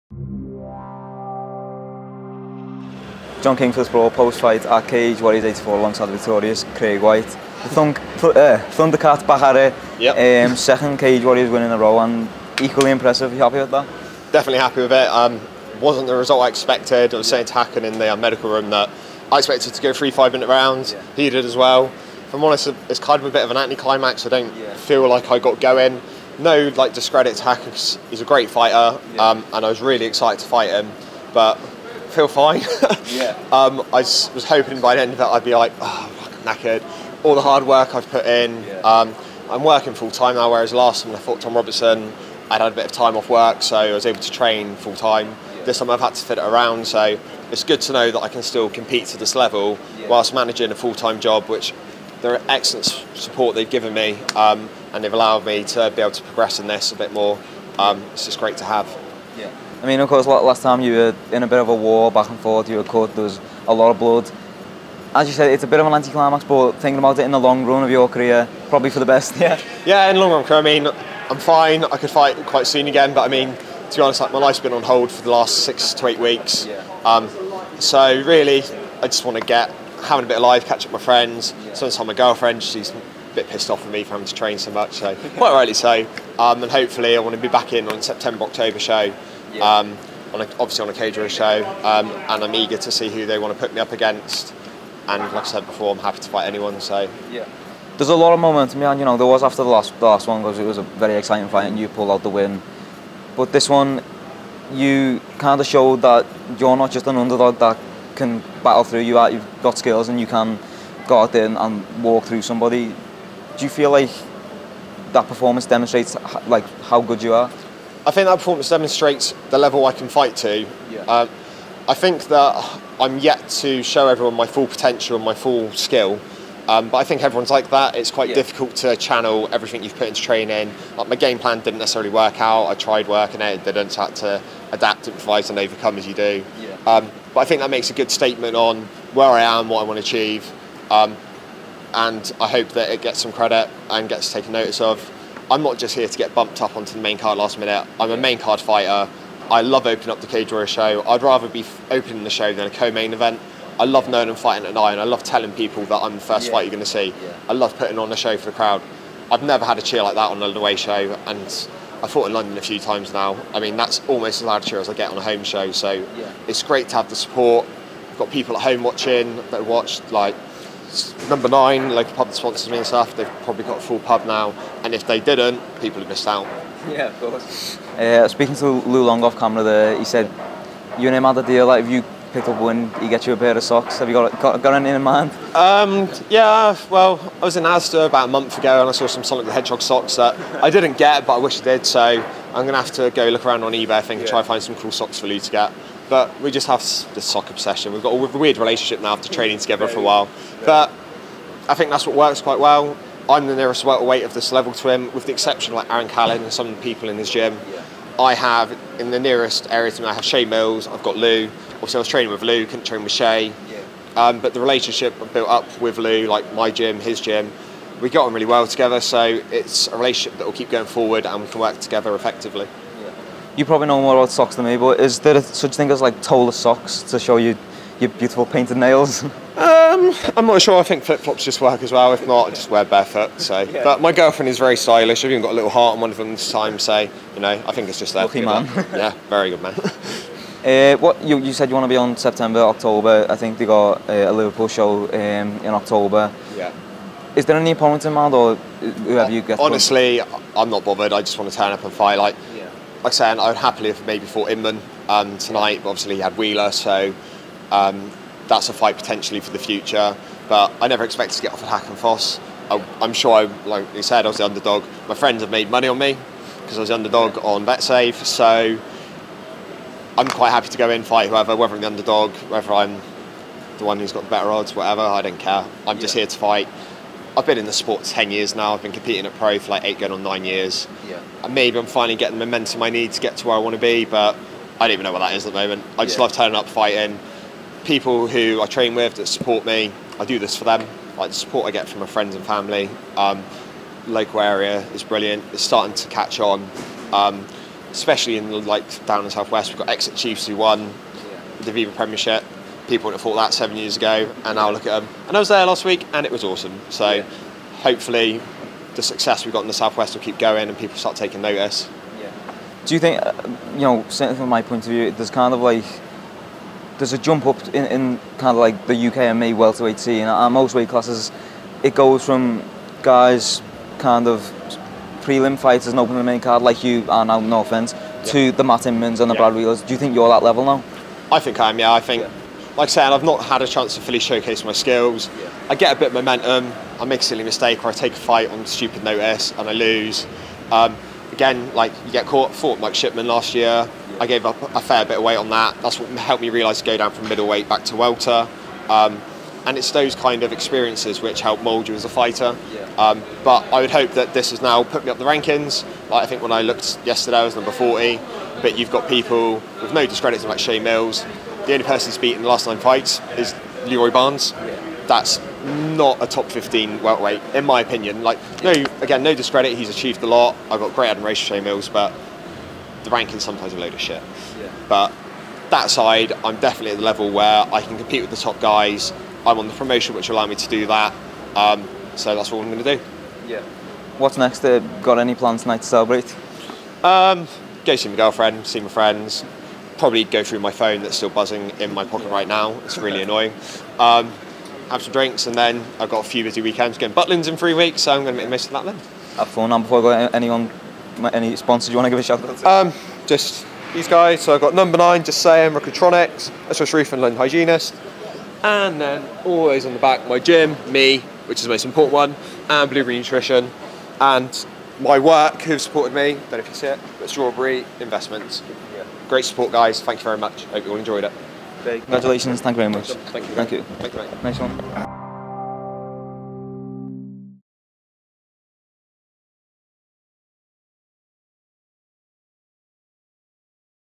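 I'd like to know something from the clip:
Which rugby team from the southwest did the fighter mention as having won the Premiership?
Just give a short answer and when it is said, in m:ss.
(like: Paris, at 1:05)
Exeter Chiefs, at 4:59.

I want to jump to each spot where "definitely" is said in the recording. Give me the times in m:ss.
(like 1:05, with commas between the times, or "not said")
0:14, 6:16.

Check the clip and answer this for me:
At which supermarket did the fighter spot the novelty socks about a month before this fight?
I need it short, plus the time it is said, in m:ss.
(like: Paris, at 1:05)
Asda, at 3:07.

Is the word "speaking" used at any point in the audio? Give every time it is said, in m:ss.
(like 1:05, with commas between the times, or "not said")
2:58.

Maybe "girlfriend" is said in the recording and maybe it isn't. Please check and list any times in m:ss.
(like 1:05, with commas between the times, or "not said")
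1:22, 3:54, 6:28.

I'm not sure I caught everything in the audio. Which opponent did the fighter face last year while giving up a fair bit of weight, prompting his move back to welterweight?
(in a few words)
Mike Shipman.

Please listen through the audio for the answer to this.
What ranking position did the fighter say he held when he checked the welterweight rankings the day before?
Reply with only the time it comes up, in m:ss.
5:57.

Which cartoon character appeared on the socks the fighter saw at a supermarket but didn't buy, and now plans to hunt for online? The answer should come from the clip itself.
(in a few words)
Sonic the Hedgehog.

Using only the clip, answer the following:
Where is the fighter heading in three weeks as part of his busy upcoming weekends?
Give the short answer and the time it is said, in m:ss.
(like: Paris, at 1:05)
Butlins, at 6:37.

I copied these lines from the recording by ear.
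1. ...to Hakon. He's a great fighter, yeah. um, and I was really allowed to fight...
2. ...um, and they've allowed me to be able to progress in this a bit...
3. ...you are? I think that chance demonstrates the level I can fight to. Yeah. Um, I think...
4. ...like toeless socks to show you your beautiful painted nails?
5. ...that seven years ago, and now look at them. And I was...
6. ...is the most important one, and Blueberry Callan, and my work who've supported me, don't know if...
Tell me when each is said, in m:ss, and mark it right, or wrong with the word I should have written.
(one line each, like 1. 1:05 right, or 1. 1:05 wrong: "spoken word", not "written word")
1. 0:27 wrong: "excited", not "allowed"
2. 0:54 right
3. 1:57 wrong: "performance", not "chance"
4. 3:46 right
5. 5:03 right
6. 6:51 wrong: "Nutrition", not "Callan".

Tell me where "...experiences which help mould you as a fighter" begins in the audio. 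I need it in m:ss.
5:50.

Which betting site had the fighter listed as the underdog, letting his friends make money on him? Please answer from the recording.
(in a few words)
BetSafe.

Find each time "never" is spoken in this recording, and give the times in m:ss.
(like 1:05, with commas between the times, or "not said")
2:39, 4:20.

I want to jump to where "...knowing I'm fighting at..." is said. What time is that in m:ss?
2:34.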